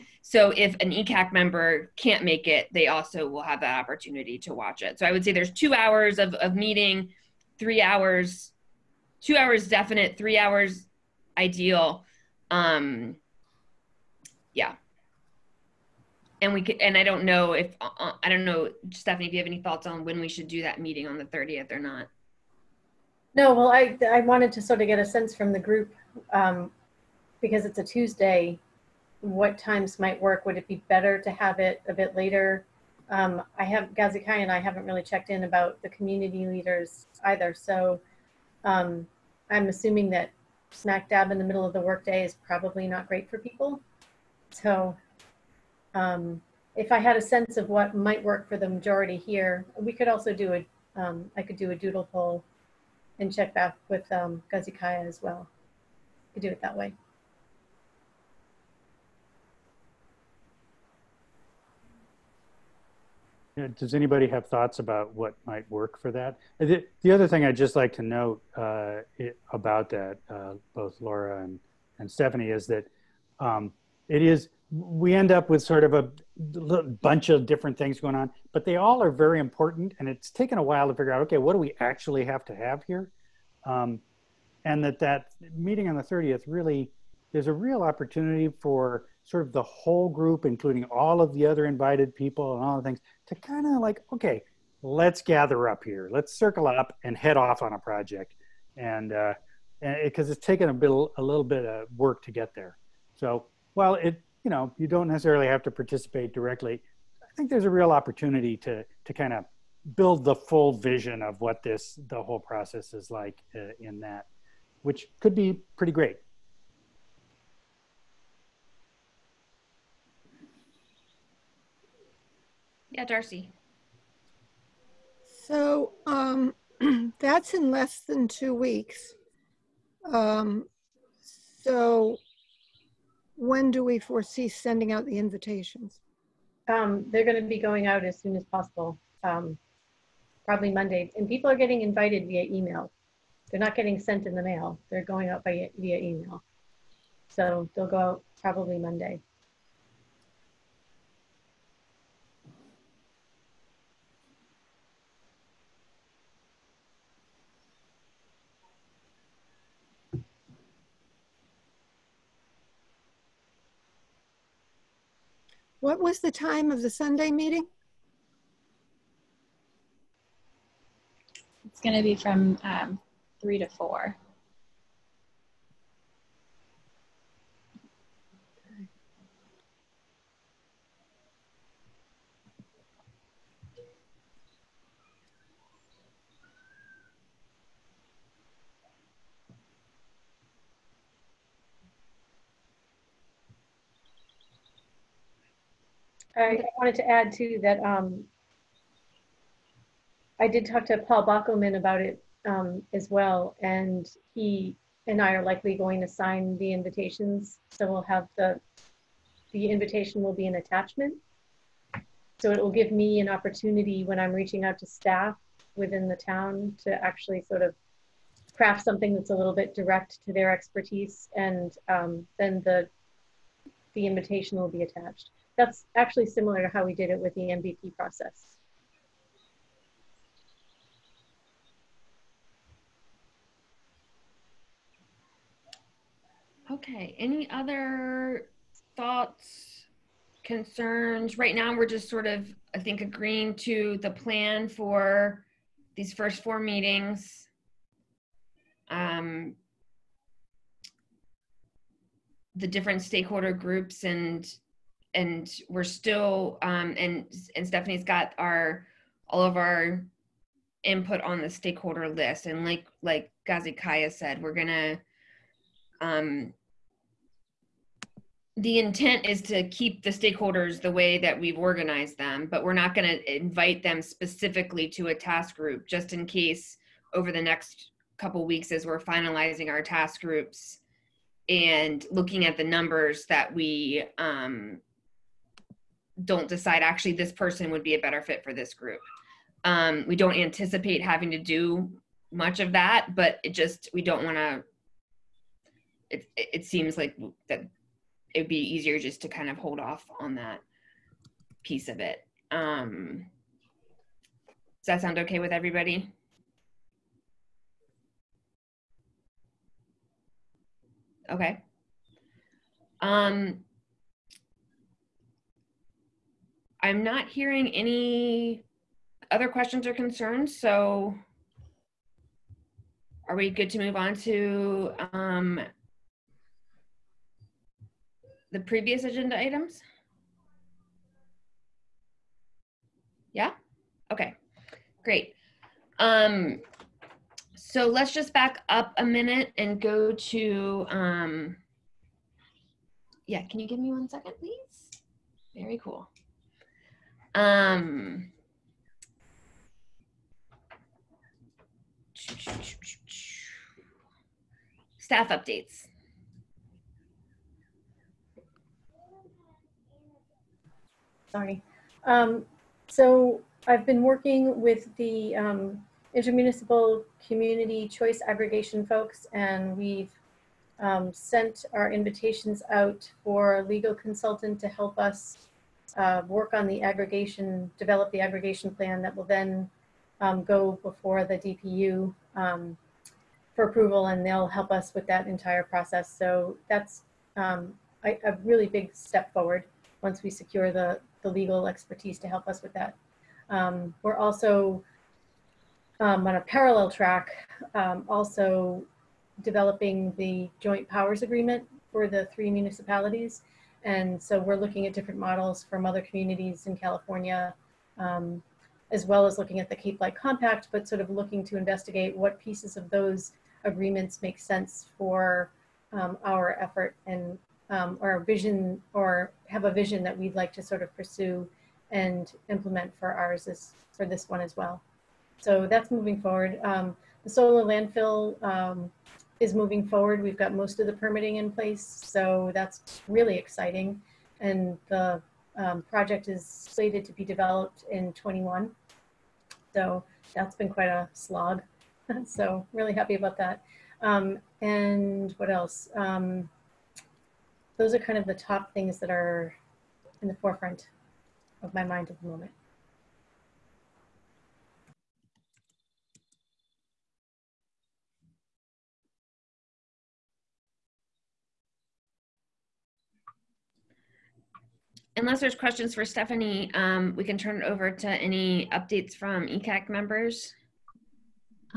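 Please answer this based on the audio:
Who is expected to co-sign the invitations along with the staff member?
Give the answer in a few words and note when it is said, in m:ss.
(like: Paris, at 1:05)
Paul Bockelman, at 3:20.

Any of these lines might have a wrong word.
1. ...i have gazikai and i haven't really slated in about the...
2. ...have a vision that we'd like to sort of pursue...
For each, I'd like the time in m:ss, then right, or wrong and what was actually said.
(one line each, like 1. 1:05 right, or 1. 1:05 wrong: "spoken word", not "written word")
1. 0:33 wrong: "checked", not "slated"
2. 6:59 right.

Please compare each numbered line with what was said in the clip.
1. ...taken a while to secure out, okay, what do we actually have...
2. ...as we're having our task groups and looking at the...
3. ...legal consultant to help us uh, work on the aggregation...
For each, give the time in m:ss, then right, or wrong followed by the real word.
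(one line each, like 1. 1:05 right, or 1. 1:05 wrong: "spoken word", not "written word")
1. 1:20 wrong: "figure", not "secure"
2. 4:38 wrong: "finalizing", not "having"
3. 6:13 right.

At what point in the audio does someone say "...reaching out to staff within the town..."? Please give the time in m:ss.
3:34.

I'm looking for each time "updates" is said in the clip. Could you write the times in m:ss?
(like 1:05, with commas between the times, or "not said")
5:55, 7:48.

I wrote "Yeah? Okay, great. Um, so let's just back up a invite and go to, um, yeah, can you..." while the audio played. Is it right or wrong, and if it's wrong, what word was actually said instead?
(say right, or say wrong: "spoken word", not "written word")
wrong: "minute", not "invite".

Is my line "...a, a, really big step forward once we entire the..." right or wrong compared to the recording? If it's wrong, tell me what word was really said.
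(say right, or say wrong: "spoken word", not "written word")
wrong: "secure", not "entire".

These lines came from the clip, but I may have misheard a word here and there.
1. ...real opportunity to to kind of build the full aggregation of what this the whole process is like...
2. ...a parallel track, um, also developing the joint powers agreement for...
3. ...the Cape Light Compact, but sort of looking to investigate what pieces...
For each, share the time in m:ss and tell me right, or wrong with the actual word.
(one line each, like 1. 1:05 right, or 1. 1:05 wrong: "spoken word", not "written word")
1. 1:47 wrong: "vision", not "aggregation"
2. 6:36 right
3. 6:49 right.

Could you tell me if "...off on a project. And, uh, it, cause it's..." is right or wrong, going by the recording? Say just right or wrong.
right.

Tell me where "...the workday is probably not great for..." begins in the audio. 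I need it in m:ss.
0:41.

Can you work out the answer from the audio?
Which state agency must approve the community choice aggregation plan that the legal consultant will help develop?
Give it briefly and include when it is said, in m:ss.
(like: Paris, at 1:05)
DPU, at 6:21.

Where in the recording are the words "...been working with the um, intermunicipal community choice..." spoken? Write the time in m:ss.
6:03.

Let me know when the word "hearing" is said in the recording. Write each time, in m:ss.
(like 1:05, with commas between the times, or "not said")
5:17.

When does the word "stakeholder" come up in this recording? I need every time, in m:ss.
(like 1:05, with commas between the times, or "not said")
4:13, 4:21, 4:30.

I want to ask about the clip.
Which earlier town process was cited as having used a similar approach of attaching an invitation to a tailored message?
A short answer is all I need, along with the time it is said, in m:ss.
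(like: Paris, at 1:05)
MVP process, at 3:47.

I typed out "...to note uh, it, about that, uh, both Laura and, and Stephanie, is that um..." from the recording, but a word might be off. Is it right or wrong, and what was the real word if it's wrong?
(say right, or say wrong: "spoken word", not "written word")
right.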